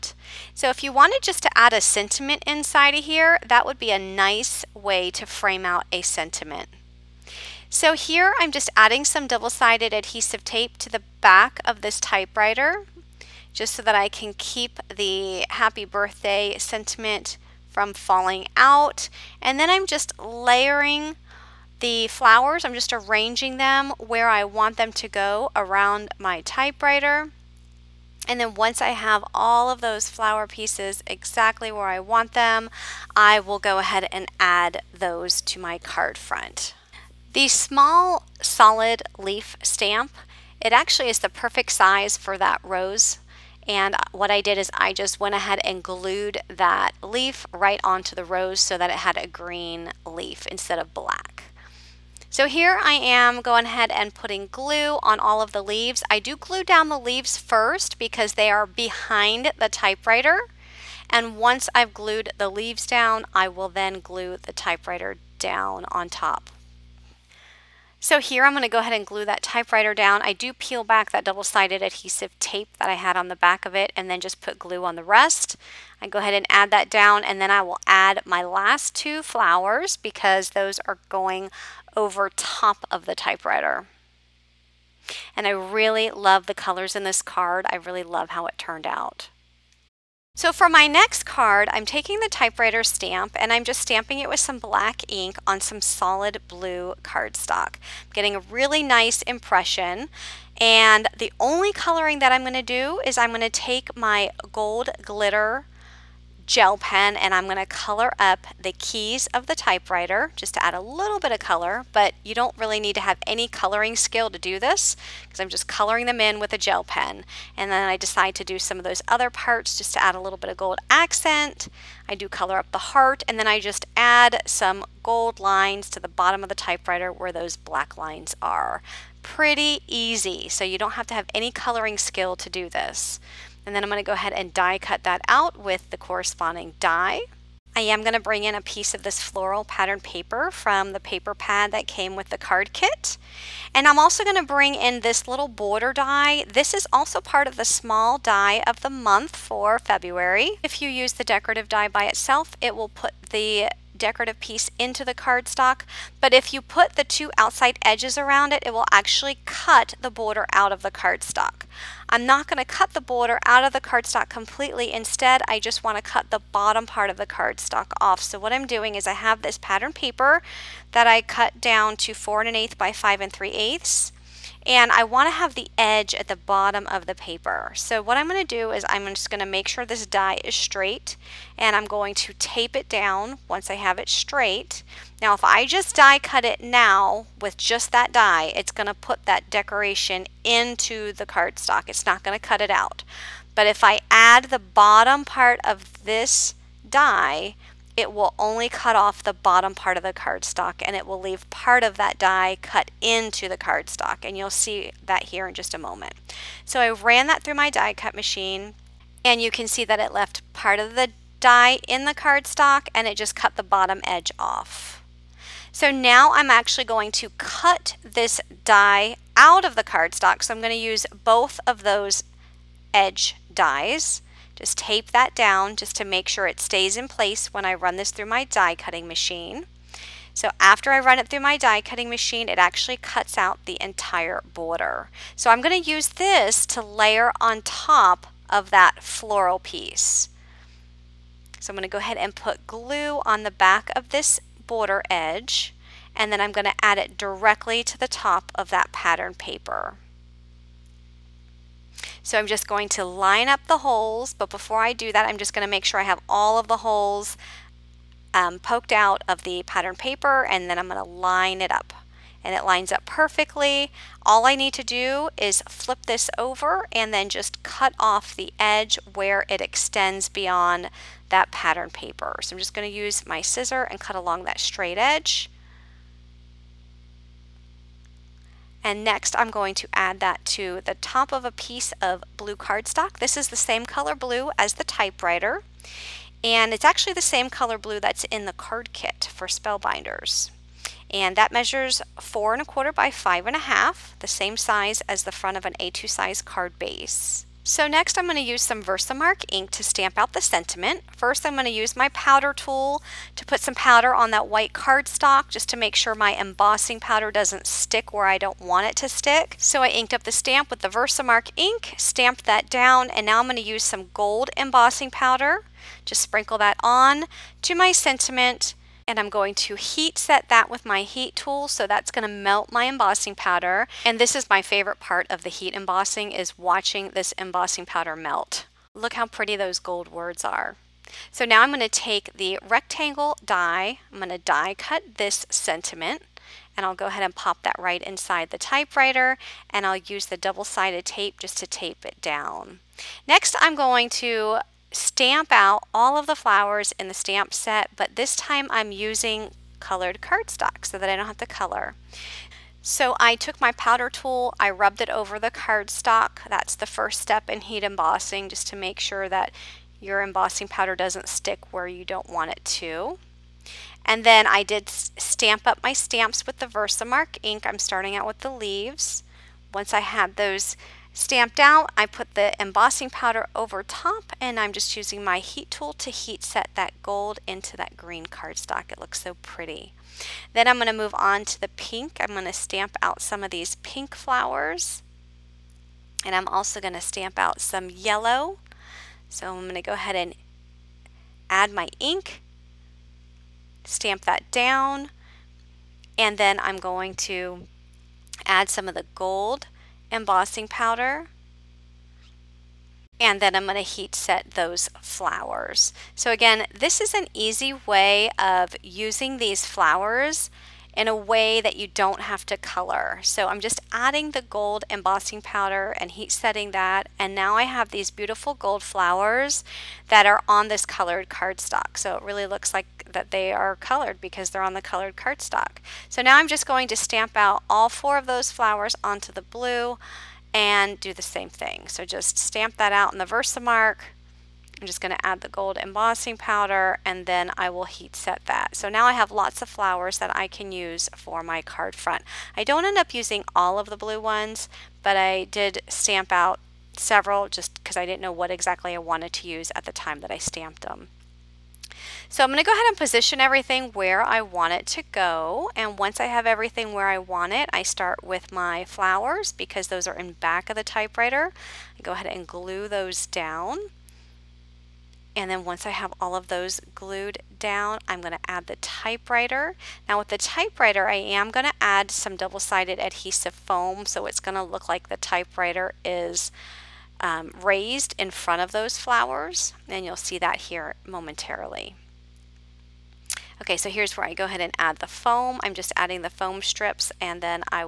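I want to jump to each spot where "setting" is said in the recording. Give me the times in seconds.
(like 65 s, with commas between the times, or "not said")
416 s.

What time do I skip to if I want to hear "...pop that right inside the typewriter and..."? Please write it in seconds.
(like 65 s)
337 s.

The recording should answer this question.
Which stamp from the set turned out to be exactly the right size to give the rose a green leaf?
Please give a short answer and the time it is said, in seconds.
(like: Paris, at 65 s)
small solid leaf stamp, at 37 s.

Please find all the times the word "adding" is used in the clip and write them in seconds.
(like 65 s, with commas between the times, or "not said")
8 s, 413 s, 485 s.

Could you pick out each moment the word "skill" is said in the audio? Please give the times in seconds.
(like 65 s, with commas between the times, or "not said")
113 s, 131 s.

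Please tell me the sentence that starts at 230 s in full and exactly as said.
So after I run it through my die cutting machine, it actually cuts out the entire border.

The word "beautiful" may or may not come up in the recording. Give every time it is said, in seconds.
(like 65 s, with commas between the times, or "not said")
418 s.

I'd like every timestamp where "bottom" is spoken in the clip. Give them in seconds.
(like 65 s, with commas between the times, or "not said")
126 s, 166 s, 176 s, 194 s, 199 s, 213 s.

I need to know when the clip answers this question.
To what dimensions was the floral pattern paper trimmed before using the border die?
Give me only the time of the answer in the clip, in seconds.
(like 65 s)
172 s.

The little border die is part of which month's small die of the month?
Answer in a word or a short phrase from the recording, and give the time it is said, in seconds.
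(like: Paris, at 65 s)
February, at 149 s.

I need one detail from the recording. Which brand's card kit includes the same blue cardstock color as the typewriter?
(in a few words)
Spellbinders.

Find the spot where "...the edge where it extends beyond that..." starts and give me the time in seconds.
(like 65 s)
268 s.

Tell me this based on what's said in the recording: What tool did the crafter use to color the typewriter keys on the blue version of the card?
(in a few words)
gold glitter gel pen.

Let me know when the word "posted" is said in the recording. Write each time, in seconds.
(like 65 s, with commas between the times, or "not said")
not said.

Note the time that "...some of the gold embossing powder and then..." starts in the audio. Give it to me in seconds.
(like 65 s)
398 s.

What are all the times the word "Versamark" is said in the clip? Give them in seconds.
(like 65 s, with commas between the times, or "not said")
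298 s, 310 s, 366 s, 433 s.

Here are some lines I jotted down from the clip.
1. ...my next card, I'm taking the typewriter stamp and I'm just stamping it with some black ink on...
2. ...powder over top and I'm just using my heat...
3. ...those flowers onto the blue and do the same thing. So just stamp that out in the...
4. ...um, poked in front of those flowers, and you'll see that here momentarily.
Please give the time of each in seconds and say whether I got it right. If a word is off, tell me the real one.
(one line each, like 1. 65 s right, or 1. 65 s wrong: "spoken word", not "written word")
1. 90 s right
2. 373 s right
3. 428 s right
4. 477 s wrong: "raised", not "poked".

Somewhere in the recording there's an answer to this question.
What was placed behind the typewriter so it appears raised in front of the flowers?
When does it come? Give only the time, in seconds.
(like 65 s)
472 s.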